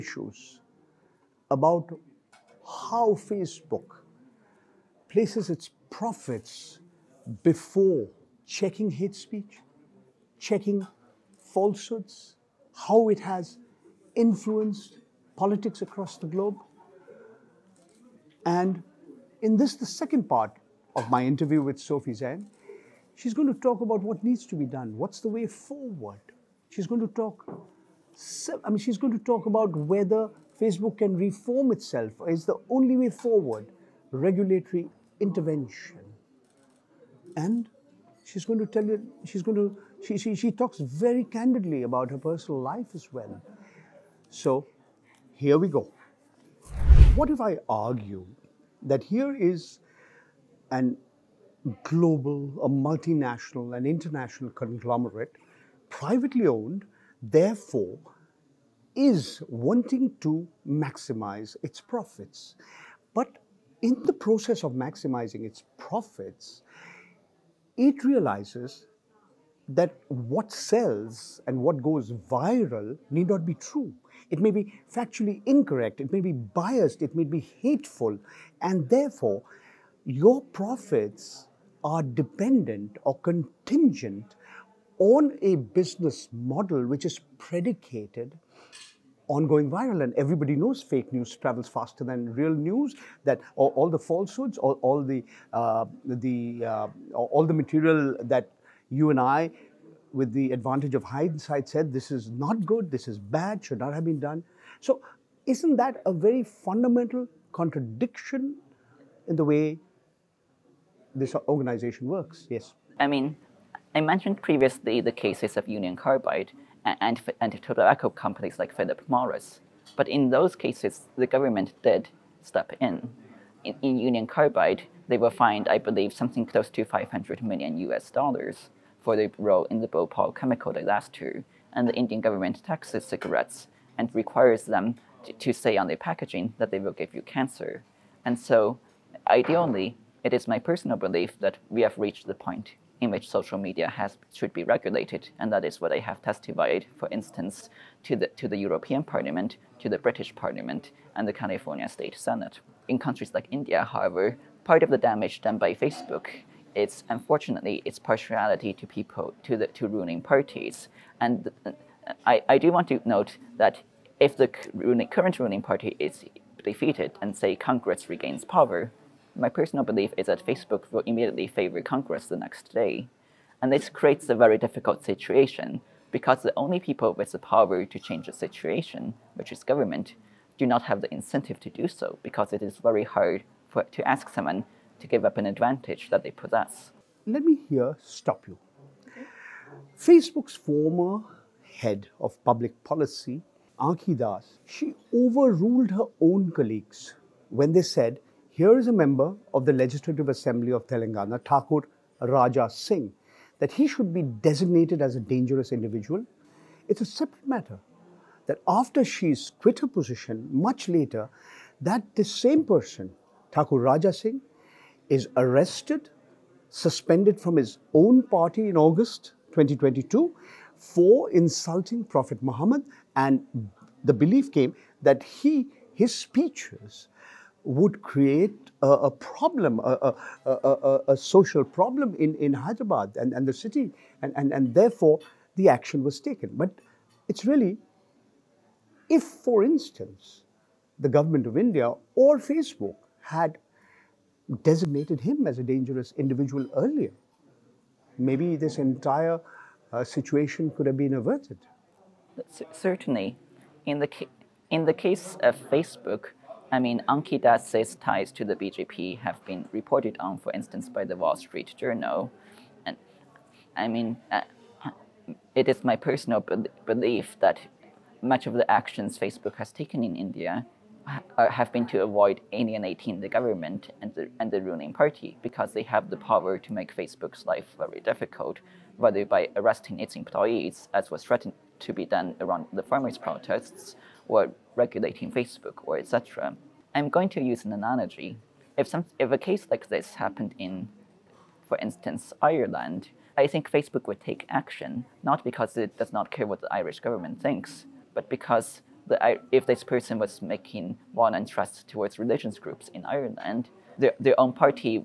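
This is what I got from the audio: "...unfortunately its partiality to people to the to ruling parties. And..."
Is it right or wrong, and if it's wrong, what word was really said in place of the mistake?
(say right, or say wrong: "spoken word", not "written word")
right.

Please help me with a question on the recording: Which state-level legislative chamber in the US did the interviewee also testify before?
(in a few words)
California State Senate.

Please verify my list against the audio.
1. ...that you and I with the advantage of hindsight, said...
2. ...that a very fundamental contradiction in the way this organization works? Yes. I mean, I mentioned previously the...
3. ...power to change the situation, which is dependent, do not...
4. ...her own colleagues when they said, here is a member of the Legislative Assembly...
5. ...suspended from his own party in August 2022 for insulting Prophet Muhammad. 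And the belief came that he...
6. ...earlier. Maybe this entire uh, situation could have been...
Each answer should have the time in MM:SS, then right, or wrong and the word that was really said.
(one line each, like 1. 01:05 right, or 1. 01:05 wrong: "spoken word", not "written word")
1. 01:38 right
2. 01:45 right
3. 02:57 wrong: "government", not "dependent"
4. 03:15 right
5. 03:36 right
6. 04:06 right.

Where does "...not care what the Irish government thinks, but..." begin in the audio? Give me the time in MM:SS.
04:56.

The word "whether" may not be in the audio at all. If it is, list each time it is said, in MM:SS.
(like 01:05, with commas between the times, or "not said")
00:29, 04:38.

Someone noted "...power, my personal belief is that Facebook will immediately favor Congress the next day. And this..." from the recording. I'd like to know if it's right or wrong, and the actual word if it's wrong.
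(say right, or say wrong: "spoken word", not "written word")
right.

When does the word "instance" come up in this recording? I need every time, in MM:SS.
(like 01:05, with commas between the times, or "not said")
02:27, 03:59, 04:20, 04:51.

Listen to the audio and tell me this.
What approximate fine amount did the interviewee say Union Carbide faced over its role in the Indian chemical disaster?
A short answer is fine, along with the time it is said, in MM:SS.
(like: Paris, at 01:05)
$500 million, at 02:06.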